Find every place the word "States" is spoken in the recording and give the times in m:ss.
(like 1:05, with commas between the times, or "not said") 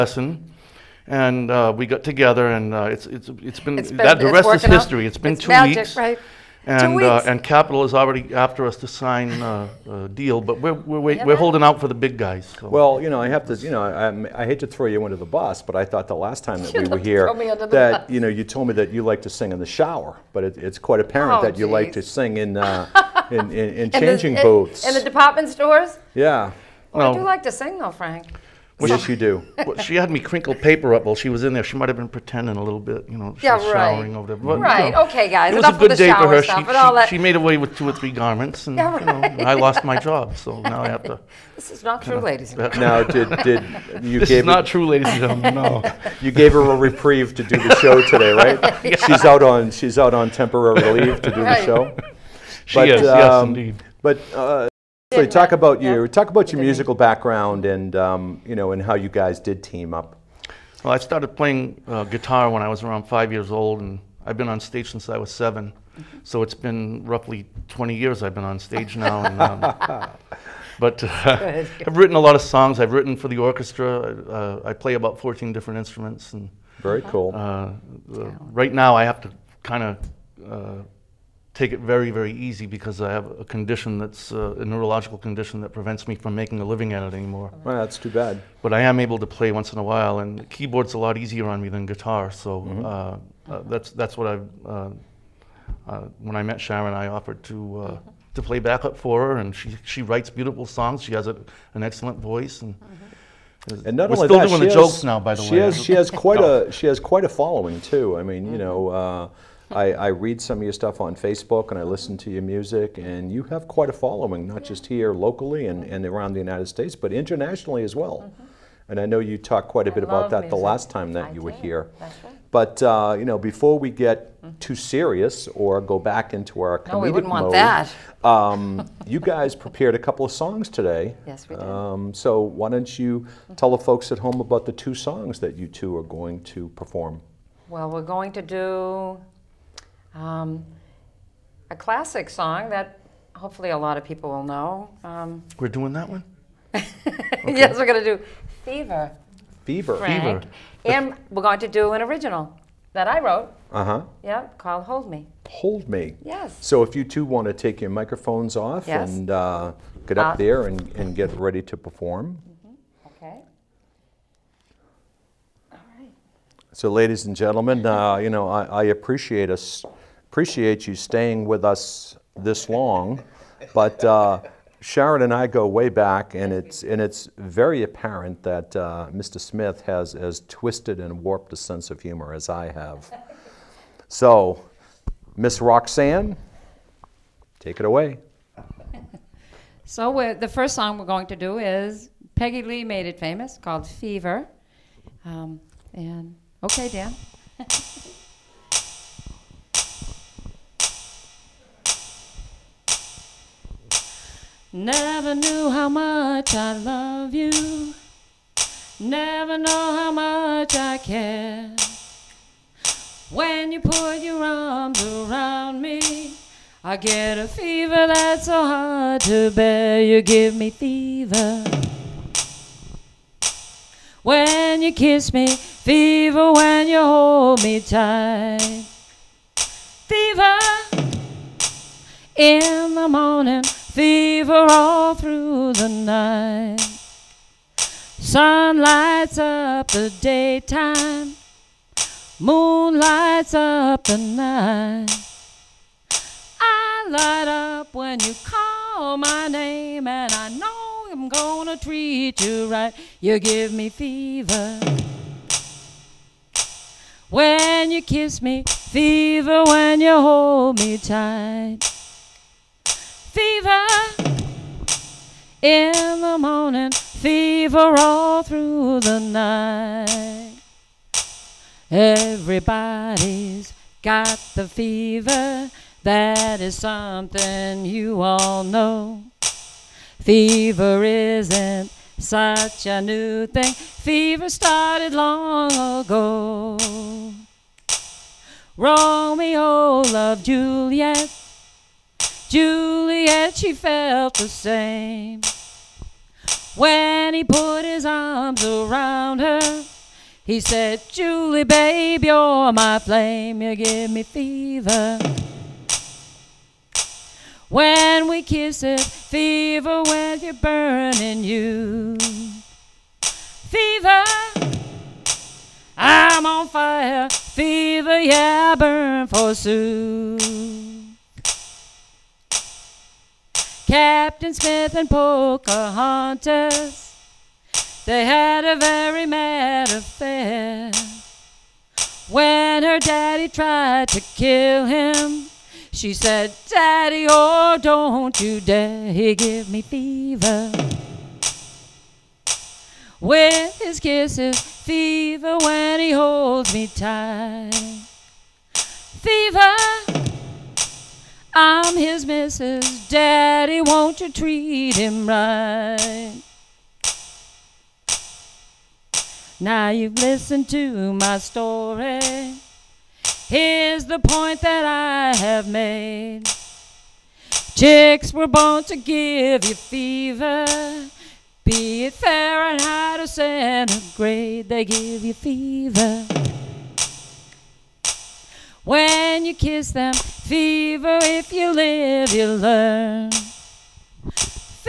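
1:56.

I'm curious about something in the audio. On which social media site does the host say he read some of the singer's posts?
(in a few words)
Facebook.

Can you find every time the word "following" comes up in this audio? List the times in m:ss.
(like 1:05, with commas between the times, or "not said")
1:47, 1:53.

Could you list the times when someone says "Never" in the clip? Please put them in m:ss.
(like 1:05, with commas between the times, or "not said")
3:24, 3:28.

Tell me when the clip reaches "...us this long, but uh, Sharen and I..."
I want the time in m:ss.
2:51.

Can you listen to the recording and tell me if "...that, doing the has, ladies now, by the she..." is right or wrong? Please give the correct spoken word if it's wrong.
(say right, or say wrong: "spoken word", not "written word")
wrong: "jokes", not "ladies".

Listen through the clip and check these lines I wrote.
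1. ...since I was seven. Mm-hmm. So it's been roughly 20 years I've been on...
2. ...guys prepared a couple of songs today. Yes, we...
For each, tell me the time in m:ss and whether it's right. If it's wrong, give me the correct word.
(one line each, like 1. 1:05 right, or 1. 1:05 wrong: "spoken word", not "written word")
1. 1:04 right
2. 2:09 right.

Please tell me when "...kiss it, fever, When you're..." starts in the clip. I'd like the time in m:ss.
5:08.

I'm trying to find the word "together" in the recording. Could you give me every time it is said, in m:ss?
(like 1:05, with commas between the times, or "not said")
0:02.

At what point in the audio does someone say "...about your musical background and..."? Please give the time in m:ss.
0:56.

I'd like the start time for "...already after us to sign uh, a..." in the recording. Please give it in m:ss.
0:07.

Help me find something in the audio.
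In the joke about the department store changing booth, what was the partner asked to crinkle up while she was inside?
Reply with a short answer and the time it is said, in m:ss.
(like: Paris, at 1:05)
paper, at 0:30.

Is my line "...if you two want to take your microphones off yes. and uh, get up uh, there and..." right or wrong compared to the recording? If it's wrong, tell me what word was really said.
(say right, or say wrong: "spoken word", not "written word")
right.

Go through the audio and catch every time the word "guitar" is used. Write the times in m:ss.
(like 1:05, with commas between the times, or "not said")
1:02, 1:31.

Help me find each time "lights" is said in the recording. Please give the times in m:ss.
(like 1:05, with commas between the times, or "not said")
3:58, 4:02, 4:07.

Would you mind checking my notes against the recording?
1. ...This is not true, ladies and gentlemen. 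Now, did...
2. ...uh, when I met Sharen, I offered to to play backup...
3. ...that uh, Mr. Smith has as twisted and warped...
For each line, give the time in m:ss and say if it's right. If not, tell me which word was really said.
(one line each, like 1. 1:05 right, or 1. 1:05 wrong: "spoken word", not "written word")
1. 0:41 right
2. 1:35 right
3. 2:58 right.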